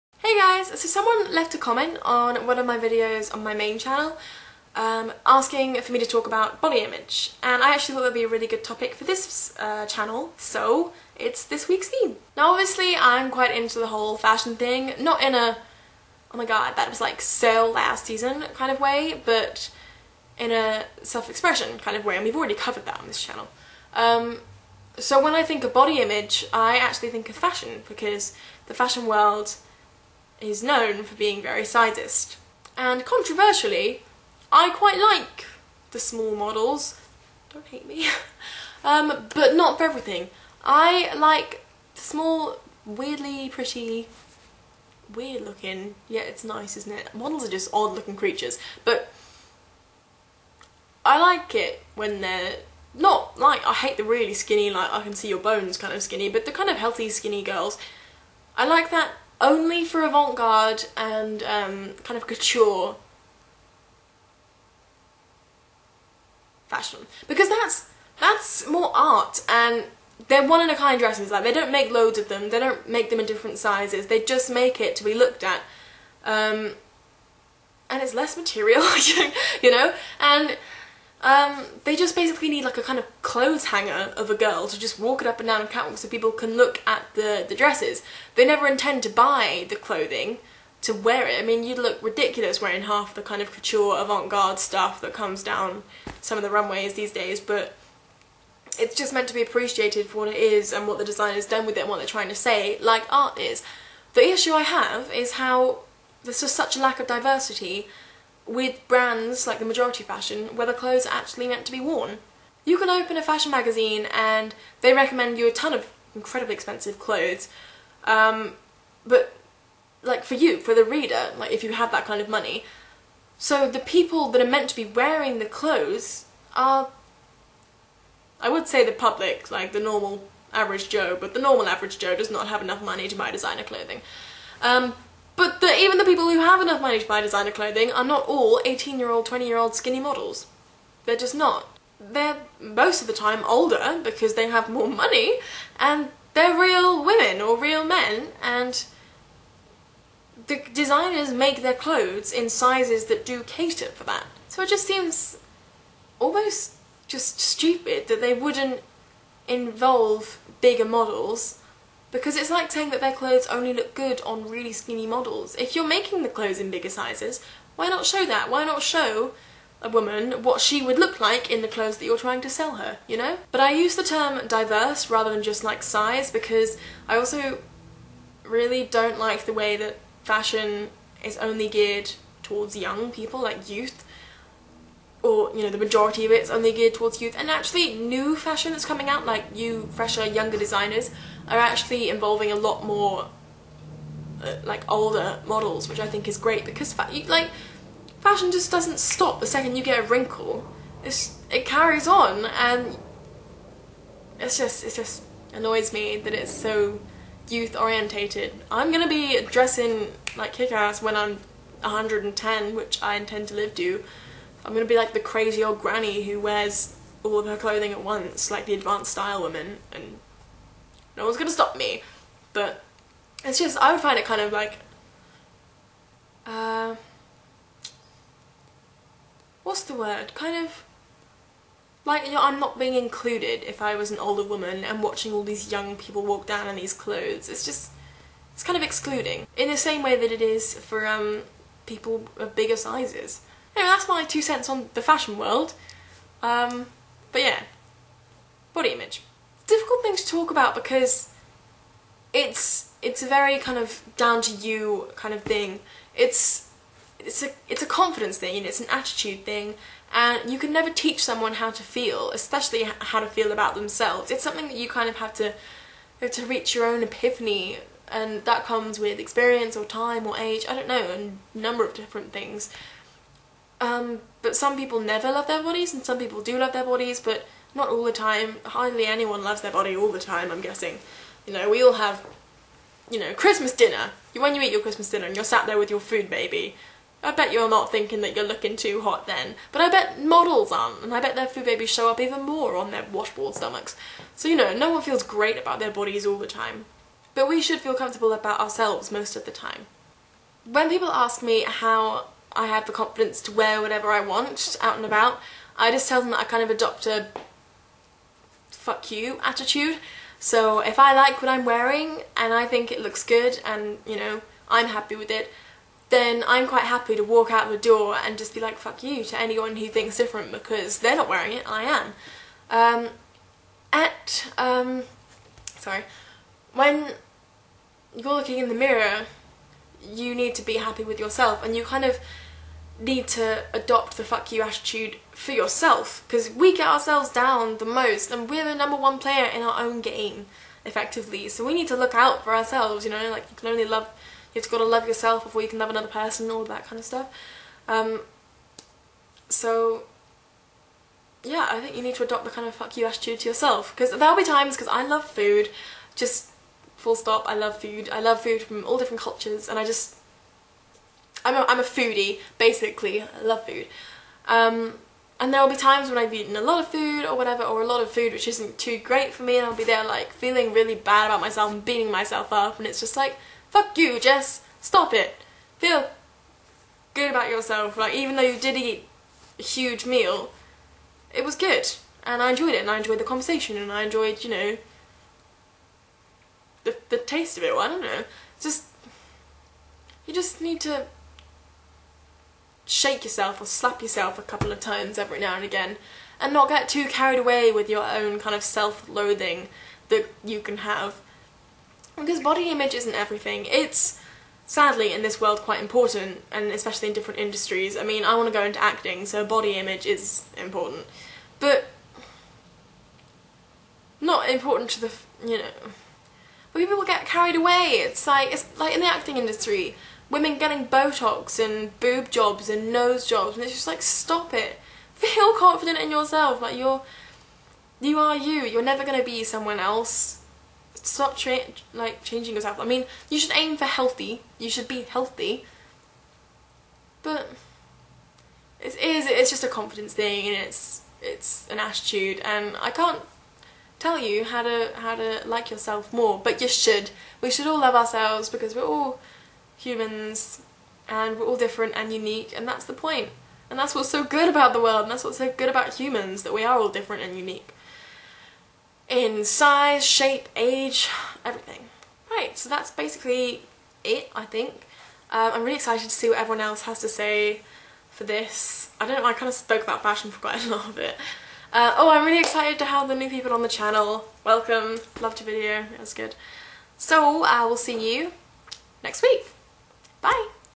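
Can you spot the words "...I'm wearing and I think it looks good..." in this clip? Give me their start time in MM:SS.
05:11.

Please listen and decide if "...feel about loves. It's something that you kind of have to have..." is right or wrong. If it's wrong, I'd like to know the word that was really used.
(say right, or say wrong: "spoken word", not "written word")
wrong: "themselves", not "loves".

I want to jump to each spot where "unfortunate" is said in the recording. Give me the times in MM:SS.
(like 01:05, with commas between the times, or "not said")
not said.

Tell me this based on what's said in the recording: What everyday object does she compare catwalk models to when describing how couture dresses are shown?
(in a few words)
clothes hanger.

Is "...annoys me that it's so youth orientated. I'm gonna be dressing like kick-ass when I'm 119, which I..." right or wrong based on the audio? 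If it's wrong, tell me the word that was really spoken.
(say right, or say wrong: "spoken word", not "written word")
wrong: "110", not "119".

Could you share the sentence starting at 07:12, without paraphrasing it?
I mean, you should aim for healthy.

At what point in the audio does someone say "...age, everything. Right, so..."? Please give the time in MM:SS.
07:40.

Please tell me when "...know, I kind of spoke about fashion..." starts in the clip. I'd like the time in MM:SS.
07:49.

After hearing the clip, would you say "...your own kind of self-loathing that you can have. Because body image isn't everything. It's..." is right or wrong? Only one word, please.
right.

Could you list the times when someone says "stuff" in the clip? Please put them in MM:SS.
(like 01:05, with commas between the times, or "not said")
01:34, 05:47.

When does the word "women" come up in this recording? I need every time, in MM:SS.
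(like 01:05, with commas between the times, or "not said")
02:27, 07:00.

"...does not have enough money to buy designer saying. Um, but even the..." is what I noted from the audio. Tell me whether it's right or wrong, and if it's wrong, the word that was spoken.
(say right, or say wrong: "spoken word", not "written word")
wrong: "clothing", not "saying".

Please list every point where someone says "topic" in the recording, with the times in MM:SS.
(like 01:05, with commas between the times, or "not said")
00:08.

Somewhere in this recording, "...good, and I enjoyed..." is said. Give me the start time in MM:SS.
06:21.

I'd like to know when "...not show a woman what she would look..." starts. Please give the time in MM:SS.
02:48.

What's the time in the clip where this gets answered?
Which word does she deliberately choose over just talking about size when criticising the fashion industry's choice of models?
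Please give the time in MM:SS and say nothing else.
02:54.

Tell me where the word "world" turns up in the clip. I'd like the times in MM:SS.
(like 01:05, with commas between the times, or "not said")
00:29, 04:05, 06:45, 07:34.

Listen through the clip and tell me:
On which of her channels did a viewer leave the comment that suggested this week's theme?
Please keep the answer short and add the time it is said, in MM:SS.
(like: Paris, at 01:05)
main channel, at 00:03.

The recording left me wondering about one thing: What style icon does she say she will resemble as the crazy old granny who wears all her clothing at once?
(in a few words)
advanced style woman.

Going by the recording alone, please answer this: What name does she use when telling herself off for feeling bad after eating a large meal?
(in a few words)
Jess.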